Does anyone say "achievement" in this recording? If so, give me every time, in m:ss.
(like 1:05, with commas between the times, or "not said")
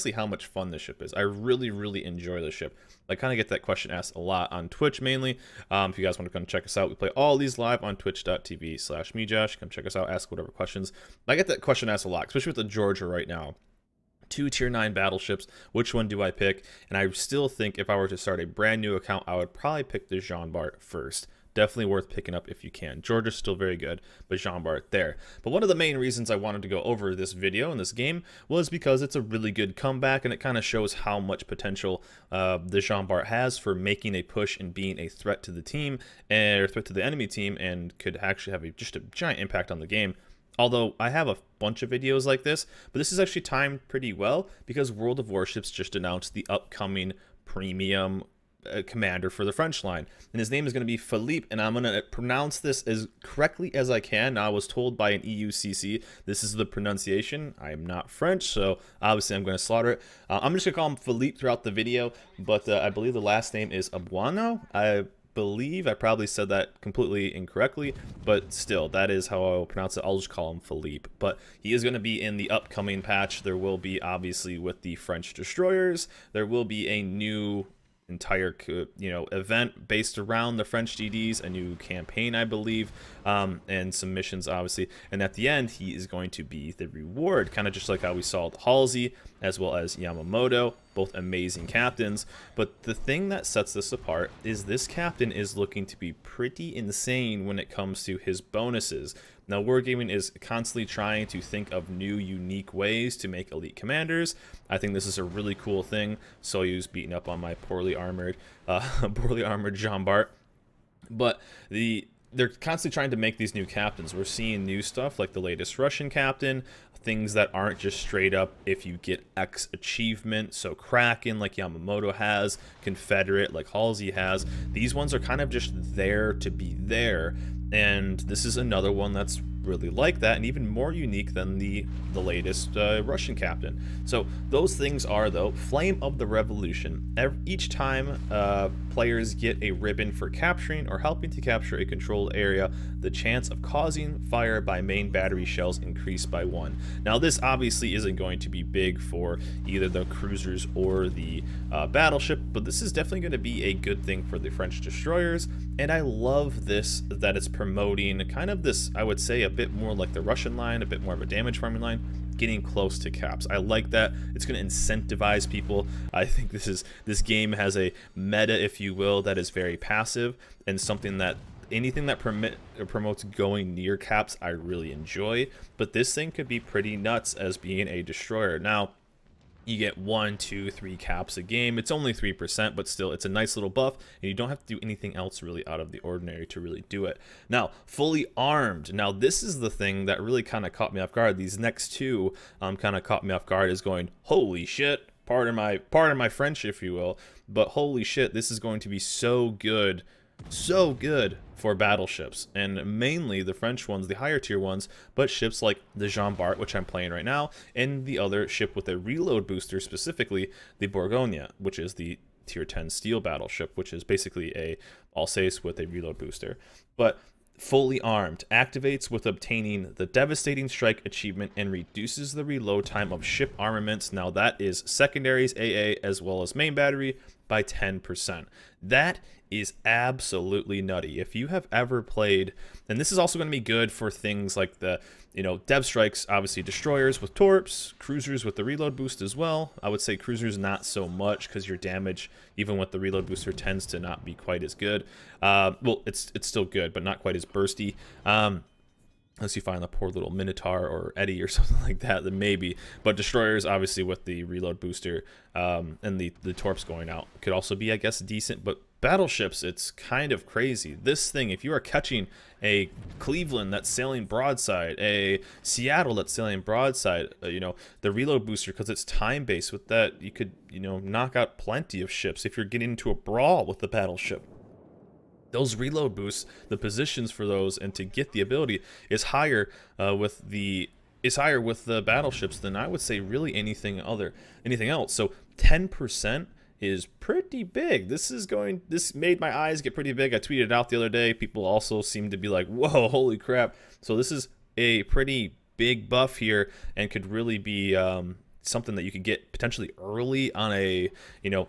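1:59, 3:41.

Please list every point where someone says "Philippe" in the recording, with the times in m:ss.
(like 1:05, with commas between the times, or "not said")
0:50, 1:00, 1:10.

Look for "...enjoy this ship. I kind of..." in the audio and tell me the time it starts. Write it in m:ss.
0:02.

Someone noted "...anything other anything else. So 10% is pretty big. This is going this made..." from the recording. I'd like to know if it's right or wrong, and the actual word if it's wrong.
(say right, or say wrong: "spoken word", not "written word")
right.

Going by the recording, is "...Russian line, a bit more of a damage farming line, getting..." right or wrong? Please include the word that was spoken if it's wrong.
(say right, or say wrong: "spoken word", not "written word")
right.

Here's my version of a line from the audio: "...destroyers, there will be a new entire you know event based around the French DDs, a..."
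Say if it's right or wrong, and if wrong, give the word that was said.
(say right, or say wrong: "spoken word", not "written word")
right.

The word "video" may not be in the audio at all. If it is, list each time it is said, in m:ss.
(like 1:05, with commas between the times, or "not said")
0:27, 0:41, 1:01.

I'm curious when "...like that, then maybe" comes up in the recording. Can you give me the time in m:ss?
4:11.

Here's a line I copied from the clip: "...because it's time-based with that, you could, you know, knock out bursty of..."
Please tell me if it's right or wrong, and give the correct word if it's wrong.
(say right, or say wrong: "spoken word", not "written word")
wrong: "plenty", not "bursty".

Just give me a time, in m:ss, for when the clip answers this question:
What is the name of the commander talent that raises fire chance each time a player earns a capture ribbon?
2:15.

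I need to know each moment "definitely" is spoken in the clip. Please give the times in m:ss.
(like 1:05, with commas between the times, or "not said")
0:21, 2:32.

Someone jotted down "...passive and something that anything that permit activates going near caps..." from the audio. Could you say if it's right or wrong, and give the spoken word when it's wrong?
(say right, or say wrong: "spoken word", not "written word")
wrong: "promotes", not "activates".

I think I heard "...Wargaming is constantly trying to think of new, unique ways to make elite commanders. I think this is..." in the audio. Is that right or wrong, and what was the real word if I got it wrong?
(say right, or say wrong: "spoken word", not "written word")
right.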